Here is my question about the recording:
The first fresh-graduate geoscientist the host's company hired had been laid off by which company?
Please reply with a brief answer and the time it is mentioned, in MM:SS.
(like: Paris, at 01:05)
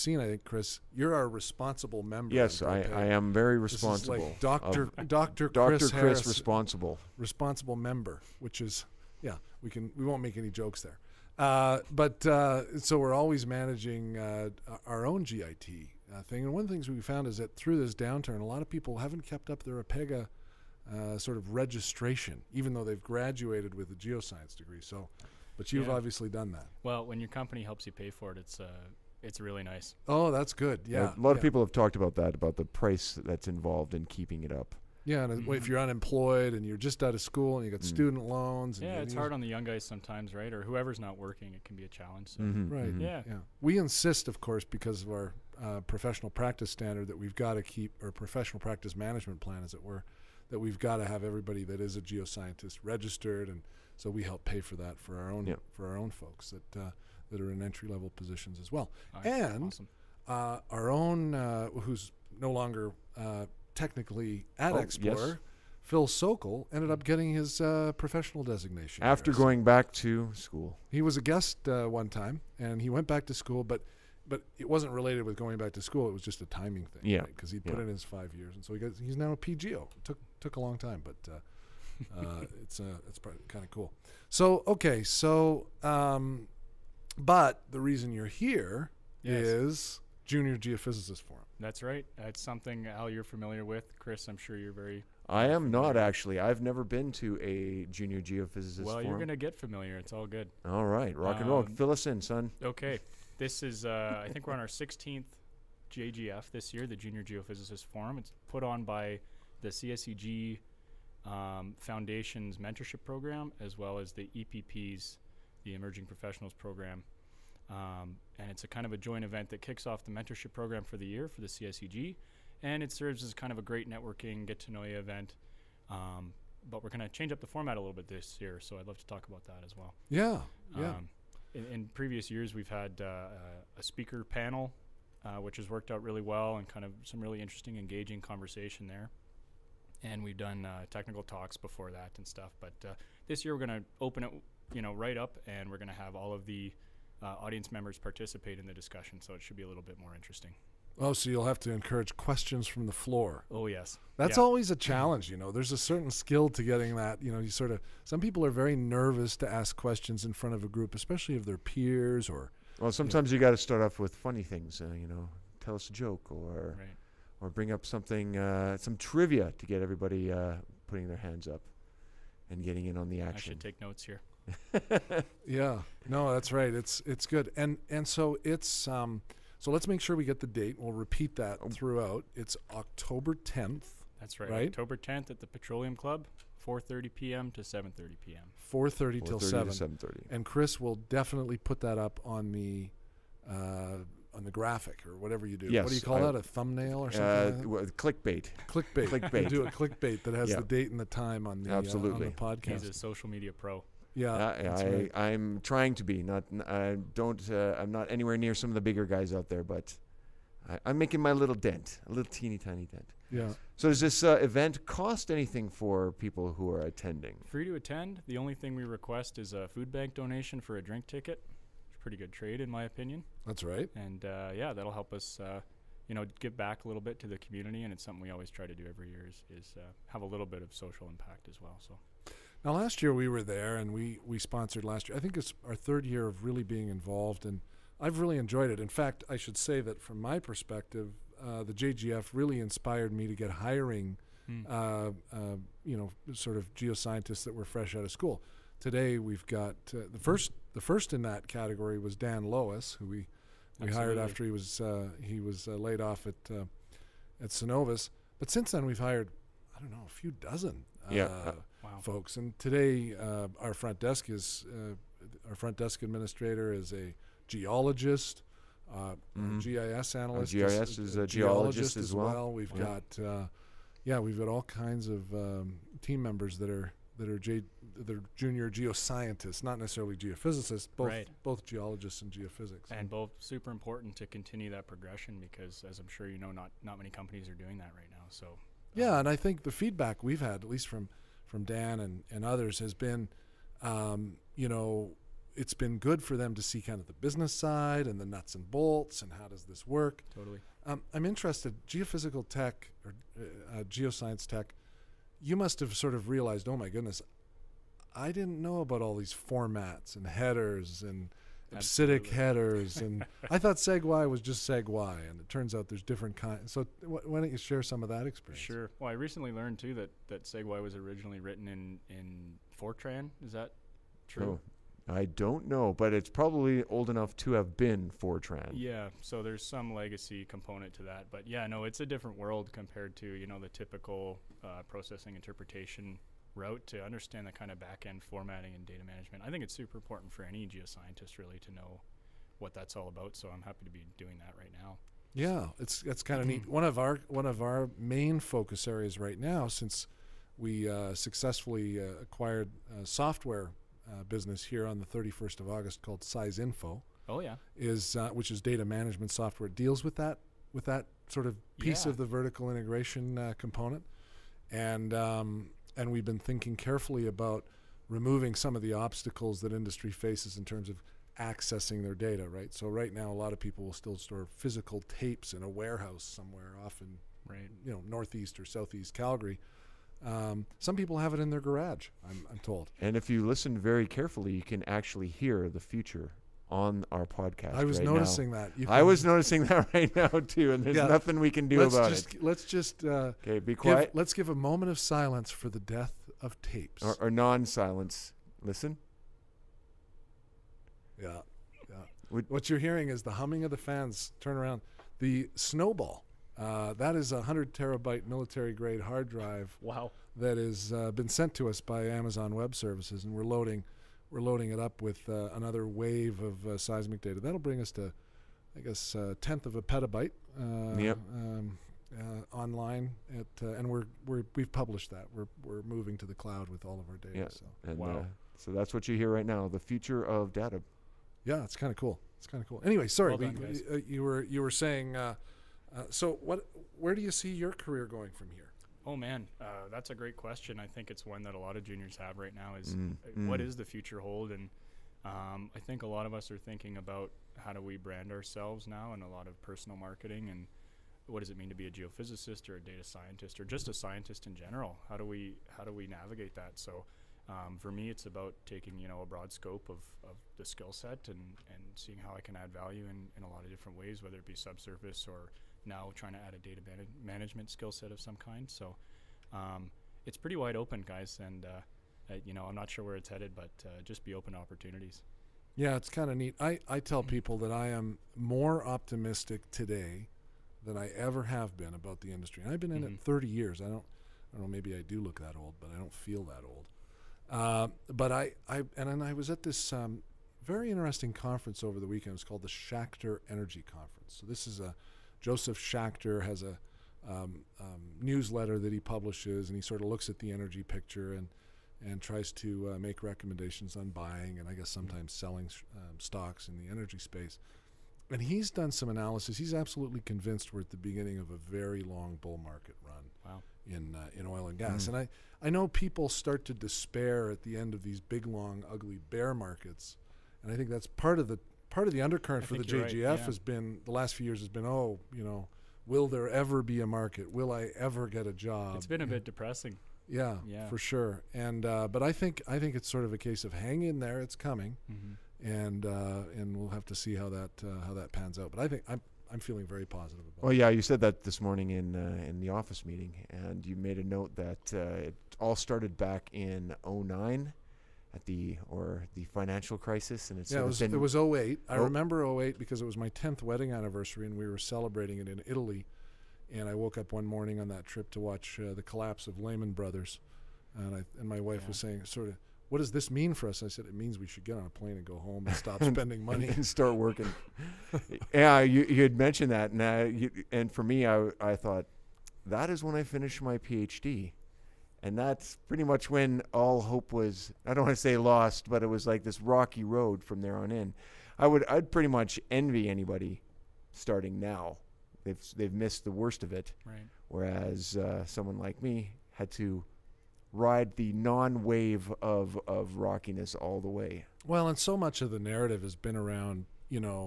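Cenovus, at 04:17.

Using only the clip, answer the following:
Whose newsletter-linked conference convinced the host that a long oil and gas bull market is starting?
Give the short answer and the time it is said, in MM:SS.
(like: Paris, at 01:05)
Josef Schachter, at 08:15.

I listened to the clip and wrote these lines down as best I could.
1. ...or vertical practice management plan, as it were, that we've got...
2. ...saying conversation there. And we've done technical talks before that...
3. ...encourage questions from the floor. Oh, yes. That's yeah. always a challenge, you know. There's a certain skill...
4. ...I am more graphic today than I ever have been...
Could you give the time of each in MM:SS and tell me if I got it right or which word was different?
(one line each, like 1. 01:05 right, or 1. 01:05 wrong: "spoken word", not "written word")
1. 00:48 wrong: "professional", not "vertical"
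2. 02:17 wrong: "engaging", not "saying"
3. 02:31 right
4. 07:57 wrong: "optimistic", not "graphic".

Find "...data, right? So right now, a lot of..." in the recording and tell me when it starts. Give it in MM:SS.
06:12.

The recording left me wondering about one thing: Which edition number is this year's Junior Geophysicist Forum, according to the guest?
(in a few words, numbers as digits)
16th.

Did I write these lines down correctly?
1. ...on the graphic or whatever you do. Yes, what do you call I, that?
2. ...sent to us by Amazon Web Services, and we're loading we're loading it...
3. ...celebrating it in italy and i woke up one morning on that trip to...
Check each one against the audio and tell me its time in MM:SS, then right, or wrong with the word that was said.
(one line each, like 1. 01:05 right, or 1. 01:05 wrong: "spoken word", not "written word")
1. 03:14 right
2. 06:51 right
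3. 09:14 right.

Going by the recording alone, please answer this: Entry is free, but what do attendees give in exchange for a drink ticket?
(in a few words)
A food bank donation.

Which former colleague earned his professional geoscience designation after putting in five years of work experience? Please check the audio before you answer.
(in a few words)
Phil Sokol.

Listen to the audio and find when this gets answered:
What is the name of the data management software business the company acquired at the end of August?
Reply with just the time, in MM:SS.
05:56.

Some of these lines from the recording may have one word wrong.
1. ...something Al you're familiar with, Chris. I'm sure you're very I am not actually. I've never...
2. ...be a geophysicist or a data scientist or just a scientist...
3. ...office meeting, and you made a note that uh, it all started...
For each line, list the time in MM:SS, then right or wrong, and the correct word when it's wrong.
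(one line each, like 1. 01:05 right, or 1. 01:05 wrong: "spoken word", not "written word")
1. 01:32 right
2. 07:31 right
3. 09:02 right.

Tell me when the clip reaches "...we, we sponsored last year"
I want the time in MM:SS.
03:53.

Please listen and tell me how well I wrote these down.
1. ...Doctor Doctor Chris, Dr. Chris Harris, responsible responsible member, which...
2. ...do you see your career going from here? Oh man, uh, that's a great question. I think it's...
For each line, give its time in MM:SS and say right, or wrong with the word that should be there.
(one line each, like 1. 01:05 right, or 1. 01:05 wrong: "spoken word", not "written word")
1. 00:04 right
2. 07:17 right.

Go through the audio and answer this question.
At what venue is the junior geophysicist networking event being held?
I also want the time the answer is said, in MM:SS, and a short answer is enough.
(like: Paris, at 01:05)
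the Petroleum Club, at 03:05.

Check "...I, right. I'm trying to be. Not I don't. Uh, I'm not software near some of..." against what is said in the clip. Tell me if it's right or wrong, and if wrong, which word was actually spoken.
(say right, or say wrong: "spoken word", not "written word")
wrong: "anywhere", not "software".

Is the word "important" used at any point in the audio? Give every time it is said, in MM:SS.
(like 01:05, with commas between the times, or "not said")
04:43, 05:39.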